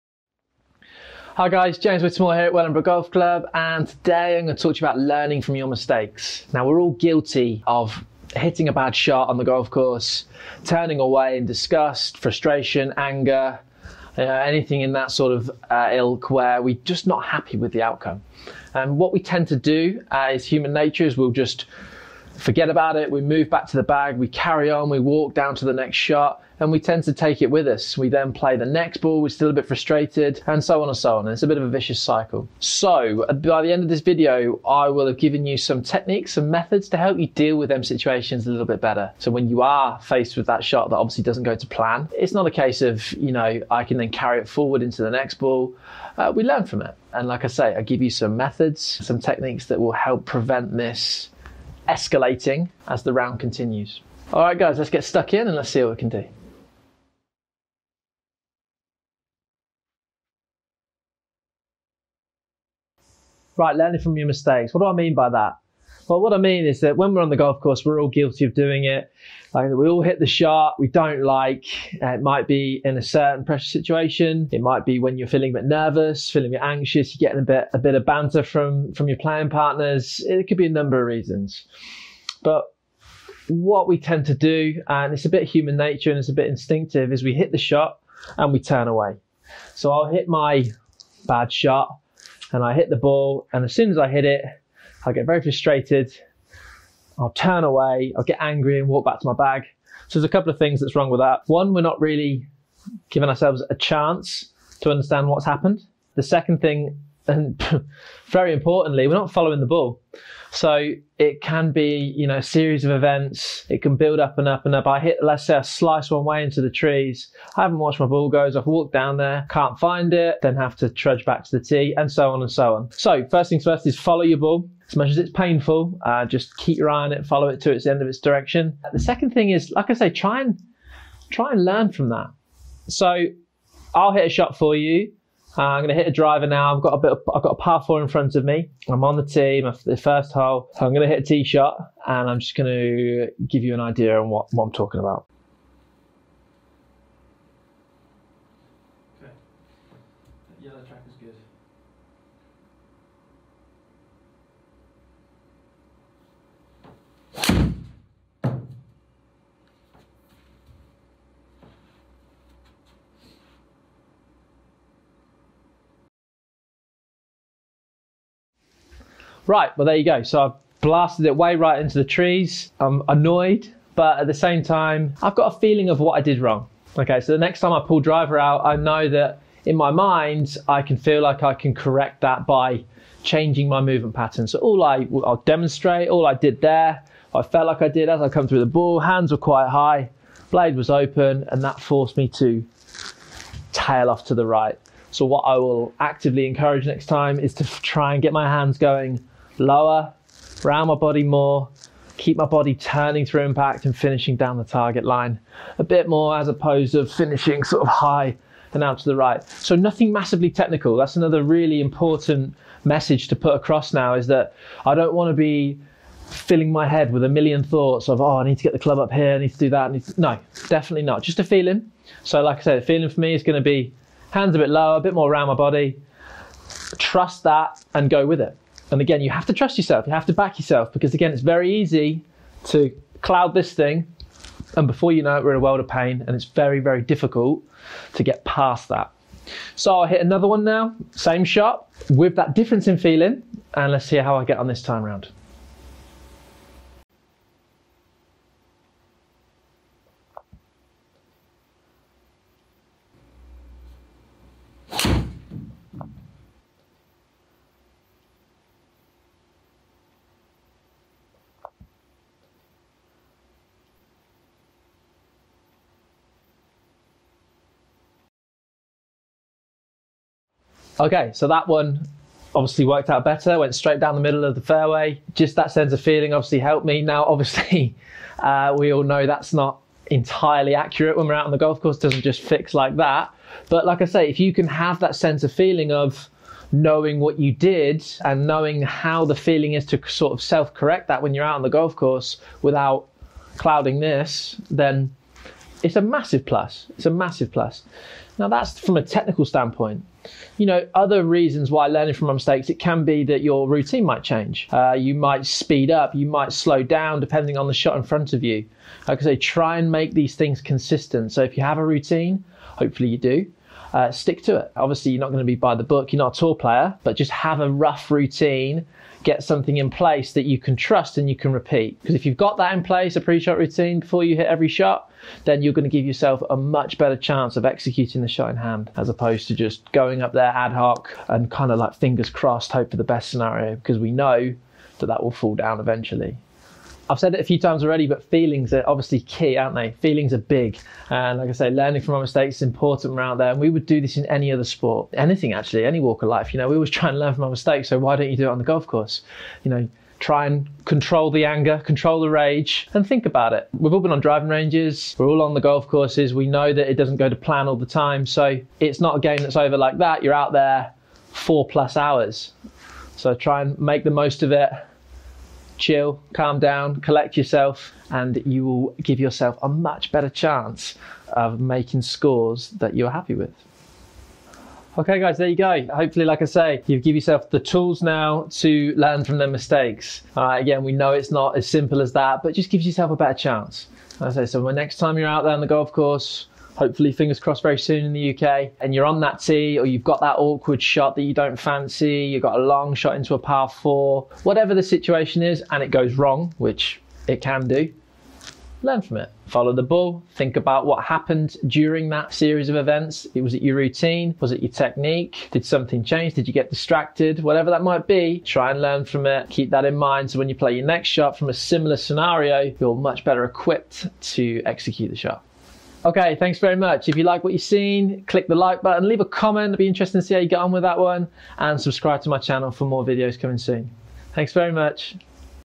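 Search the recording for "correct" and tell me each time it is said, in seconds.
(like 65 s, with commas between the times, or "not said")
181 s, 290 s.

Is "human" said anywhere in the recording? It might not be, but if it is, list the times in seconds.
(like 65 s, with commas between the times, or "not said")
20 s, 85 s.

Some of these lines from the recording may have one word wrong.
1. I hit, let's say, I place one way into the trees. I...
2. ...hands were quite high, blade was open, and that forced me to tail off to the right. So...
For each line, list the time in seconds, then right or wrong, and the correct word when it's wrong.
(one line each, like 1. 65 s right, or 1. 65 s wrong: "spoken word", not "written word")
1. 114 s wrong: "slice", not "place"
2. 188 s right.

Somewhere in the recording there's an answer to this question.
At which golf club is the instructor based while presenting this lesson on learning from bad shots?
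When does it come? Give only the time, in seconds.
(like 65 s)
2 s.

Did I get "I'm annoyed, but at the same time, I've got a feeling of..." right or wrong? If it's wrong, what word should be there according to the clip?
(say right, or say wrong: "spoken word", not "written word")
right.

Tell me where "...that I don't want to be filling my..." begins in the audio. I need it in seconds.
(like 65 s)
214 s.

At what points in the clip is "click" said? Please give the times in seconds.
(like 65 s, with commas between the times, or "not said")
418 s.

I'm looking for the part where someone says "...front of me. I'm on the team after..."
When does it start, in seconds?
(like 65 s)
138 s.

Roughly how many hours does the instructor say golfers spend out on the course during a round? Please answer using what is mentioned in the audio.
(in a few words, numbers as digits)
4 plus hours.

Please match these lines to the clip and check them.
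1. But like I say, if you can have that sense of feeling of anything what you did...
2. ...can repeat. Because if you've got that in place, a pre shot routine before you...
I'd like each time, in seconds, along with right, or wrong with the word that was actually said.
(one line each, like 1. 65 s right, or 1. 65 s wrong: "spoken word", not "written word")
1. 283 s wrong: "knowing", not "anything"
2. 321 s right.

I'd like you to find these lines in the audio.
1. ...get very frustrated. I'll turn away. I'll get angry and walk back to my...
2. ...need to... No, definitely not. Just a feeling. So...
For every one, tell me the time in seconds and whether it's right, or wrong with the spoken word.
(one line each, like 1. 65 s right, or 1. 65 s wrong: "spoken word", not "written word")
1. 95 s right
2. 219 s right.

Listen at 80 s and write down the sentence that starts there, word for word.
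It could be a number of reasons.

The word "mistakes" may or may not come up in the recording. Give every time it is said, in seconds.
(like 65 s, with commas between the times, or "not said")
5 s, 64 s, 302 s, 342 s, 347 s, 379 s.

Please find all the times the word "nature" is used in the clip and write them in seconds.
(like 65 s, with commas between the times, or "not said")
20 s, 85 s.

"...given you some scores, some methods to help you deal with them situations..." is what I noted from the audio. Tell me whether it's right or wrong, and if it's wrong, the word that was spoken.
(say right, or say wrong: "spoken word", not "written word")
wrong: "techniques", not "scores".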